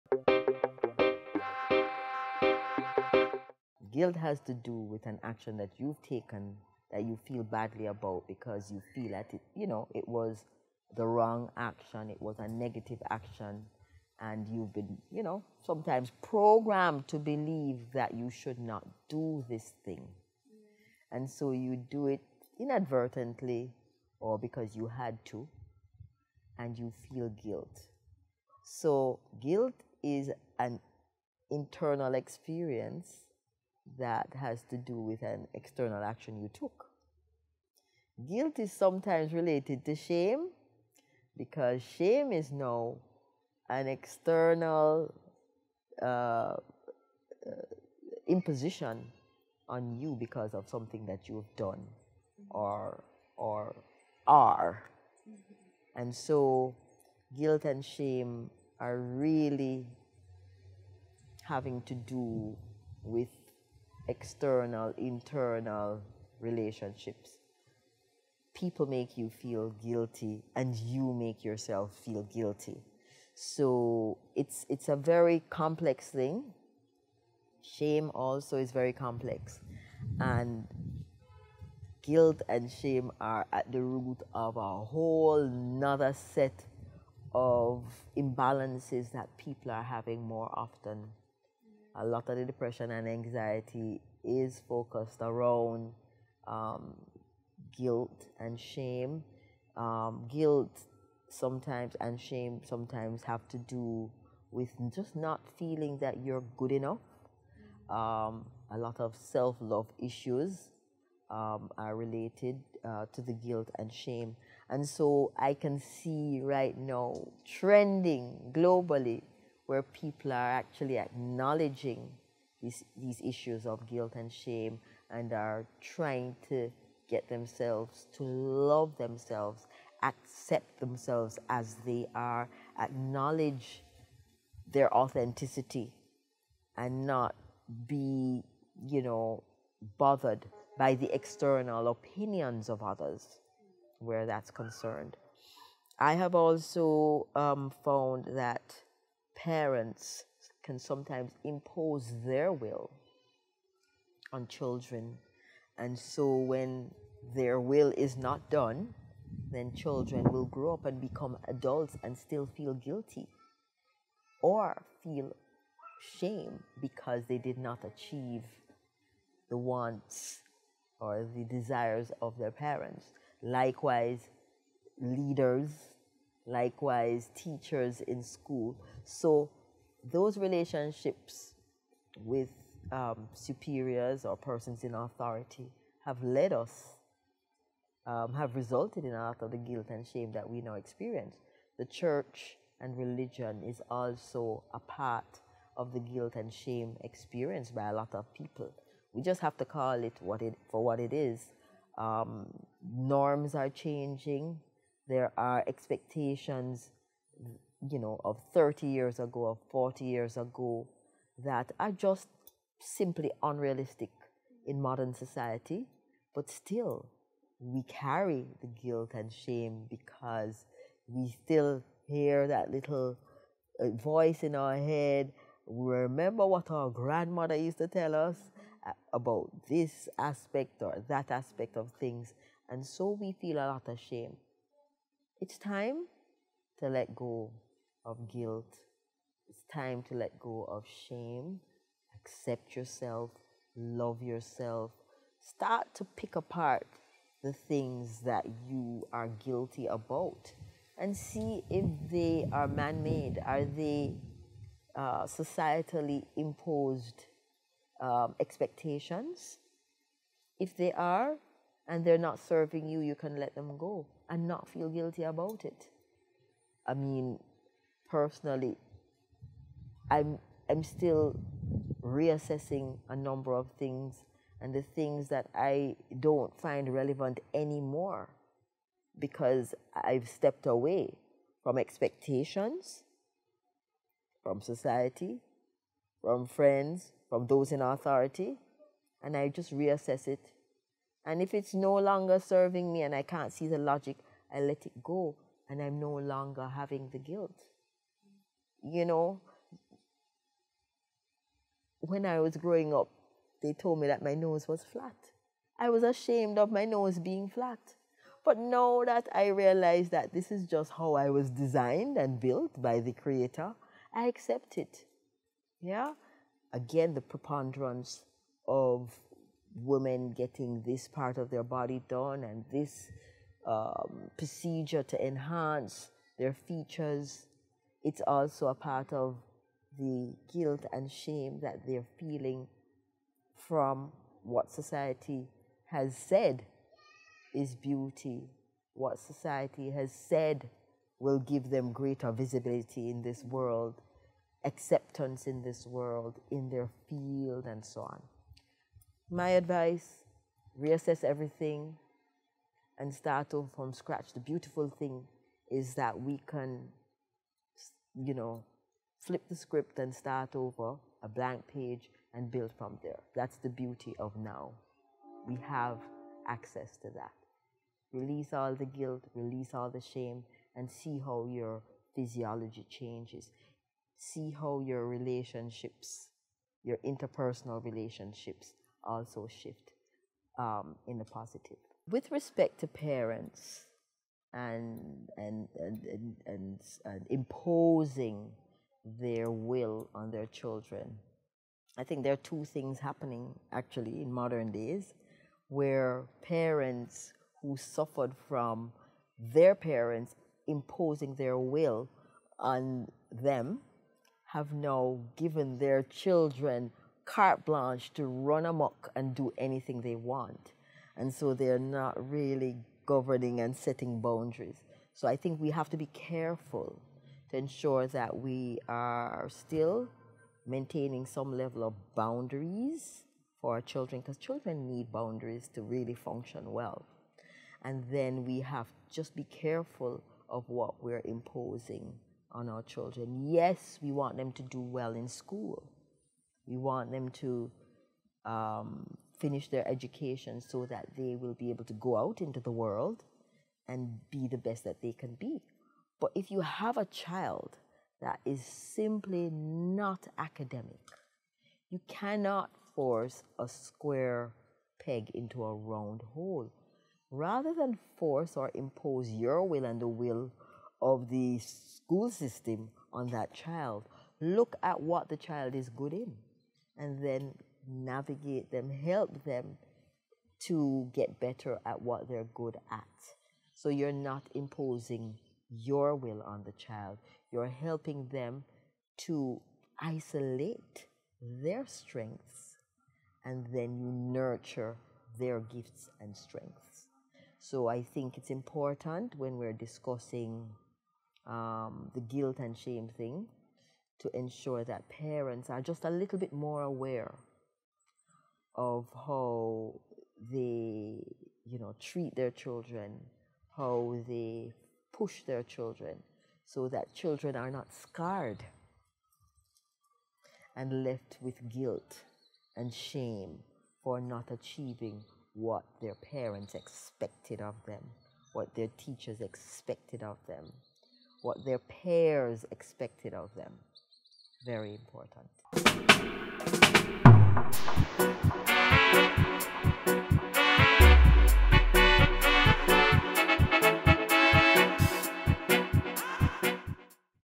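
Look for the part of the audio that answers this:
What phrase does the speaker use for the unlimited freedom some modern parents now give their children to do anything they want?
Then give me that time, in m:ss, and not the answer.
6:47.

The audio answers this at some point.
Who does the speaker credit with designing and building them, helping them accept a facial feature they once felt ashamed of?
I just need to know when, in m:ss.
5:12.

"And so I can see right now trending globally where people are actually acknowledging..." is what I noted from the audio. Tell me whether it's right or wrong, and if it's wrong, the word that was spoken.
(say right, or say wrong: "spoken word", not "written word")
right.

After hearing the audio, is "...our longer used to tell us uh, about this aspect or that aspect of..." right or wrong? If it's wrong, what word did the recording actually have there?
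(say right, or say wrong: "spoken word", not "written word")
wrong: "grandmother", not "longer".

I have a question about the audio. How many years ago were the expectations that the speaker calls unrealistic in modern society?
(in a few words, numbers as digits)
30.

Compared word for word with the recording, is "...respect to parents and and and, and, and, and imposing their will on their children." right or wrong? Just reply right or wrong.
right.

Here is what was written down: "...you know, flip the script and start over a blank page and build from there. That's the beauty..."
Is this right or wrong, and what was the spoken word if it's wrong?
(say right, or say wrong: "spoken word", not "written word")
right.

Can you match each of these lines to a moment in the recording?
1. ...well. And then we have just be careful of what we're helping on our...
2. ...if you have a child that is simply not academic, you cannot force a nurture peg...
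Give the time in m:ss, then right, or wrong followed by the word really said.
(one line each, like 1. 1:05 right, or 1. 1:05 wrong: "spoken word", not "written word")
1. 7:06 wrong: "imposing", not "helping"
2. 7:26 wrong: "square", not "nurture".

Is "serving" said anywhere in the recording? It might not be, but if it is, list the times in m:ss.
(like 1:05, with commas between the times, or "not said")
4:22, 4:52.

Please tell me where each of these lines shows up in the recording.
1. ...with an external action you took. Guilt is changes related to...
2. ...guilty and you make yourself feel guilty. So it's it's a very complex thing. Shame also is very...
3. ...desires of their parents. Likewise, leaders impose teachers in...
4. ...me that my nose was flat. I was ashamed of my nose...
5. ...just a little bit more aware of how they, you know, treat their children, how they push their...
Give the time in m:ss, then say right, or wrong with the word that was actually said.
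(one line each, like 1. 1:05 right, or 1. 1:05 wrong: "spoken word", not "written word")
1. 0:35 wrong: "sometimes", not "changes"
2. 1:09 right
3. 2:51 wrong: "likewise", not "impose"
4. 5:03 right
5. 8:15 right.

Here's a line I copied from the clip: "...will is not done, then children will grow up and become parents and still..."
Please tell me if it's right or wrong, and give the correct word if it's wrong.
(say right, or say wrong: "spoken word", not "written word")
wrong: "adults", not "parents".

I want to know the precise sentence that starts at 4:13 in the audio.
Are they uh, societally imposed um, expectations?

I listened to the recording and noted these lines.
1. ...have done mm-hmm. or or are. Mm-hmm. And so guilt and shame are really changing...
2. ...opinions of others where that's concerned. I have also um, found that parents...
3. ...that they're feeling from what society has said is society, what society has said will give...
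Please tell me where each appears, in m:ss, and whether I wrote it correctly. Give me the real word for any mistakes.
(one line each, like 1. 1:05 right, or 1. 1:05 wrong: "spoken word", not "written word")
1. 0:51 wrong: "having", not "changing"
2. 2:21 right
3. 5:31 wrong: "beauty", not "society".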